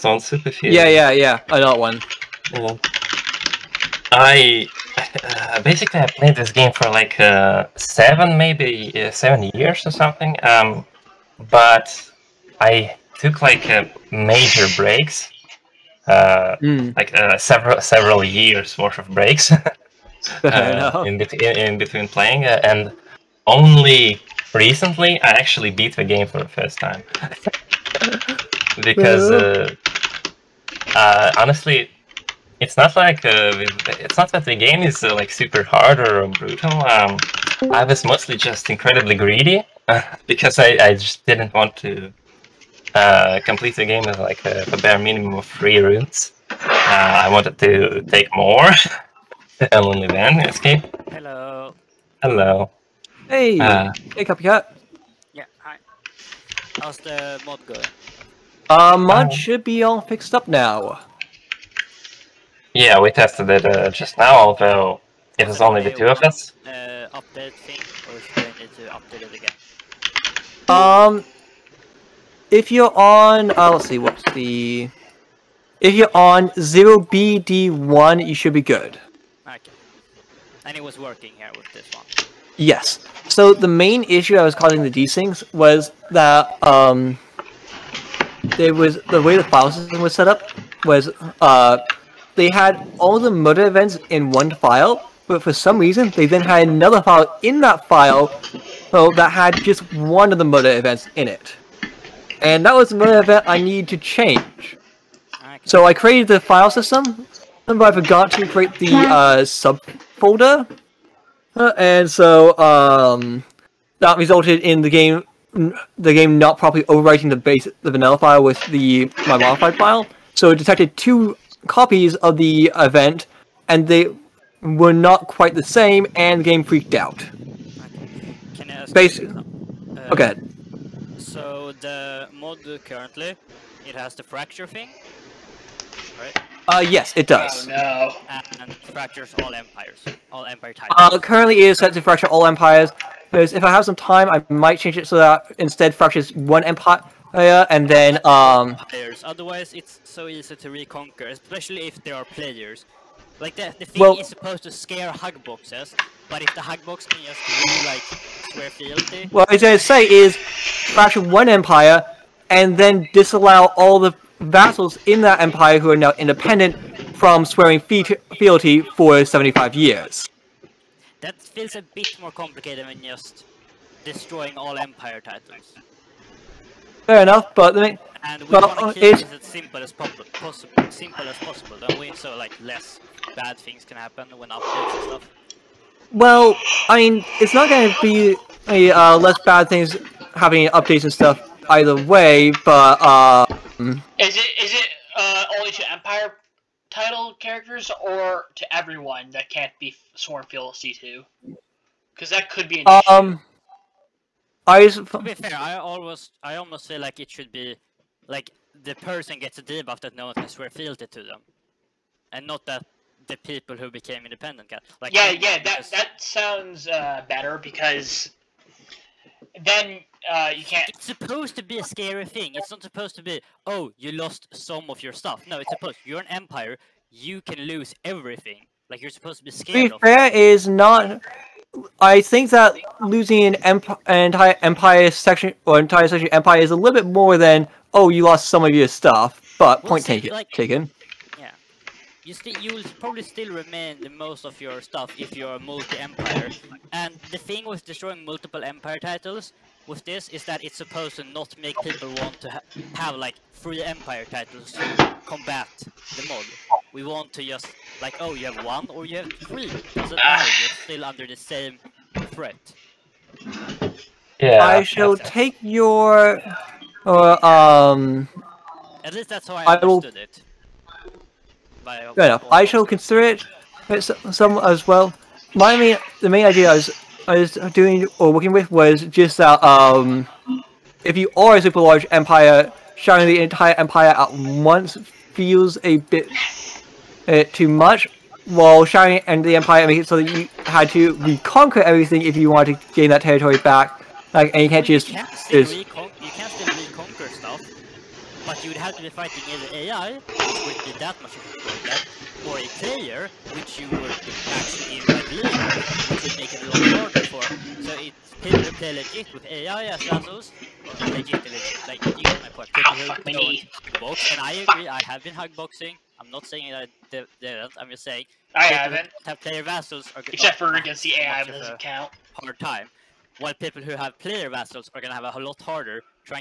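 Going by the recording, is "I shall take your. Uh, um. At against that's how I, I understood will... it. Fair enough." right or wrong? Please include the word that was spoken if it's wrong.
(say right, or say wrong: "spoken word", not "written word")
wrong: "least", not "against".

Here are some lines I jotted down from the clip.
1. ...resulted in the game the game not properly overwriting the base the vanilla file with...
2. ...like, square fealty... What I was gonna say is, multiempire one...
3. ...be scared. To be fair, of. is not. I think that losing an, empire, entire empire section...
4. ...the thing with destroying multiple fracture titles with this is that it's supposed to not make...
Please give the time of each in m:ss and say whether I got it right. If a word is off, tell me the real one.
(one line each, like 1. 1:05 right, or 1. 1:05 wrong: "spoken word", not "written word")
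1. 1:54 right
2. 2:37 wrong: "fracture", not "multiempire"
3. 3:49 right
4. 4:07 wrong: "empire", not "fracture".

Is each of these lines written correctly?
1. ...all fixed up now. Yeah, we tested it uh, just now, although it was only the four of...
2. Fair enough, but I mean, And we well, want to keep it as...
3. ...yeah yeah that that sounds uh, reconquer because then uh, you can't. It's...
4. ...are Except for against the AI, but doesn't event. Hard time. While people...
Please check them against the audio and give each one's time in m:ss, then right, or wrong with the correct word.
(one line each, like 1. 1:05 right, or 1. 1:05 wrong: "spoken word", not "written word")
1. 0:59 wrong: "two", not "four"
2. 2:57 right
3. 3:35 wrong: "better", not "reconquer"
4. 5:20 wrong: "count", not "event".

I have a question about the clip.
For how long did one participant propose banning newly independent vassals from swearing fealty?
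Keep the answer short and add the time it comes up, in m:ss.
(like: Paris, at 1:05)
75 years, at 2:49.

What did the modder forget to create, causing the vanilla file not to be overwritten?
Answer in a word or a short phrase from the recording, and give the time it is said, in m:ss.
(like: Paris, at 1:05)
sub folder, at 1:49.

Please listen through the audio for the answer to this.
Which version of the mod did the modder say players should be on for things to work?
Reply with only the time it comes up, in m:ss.
1:16.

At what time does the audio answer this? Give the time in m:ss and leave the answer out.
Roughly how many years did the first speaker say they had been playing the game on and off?
0:09.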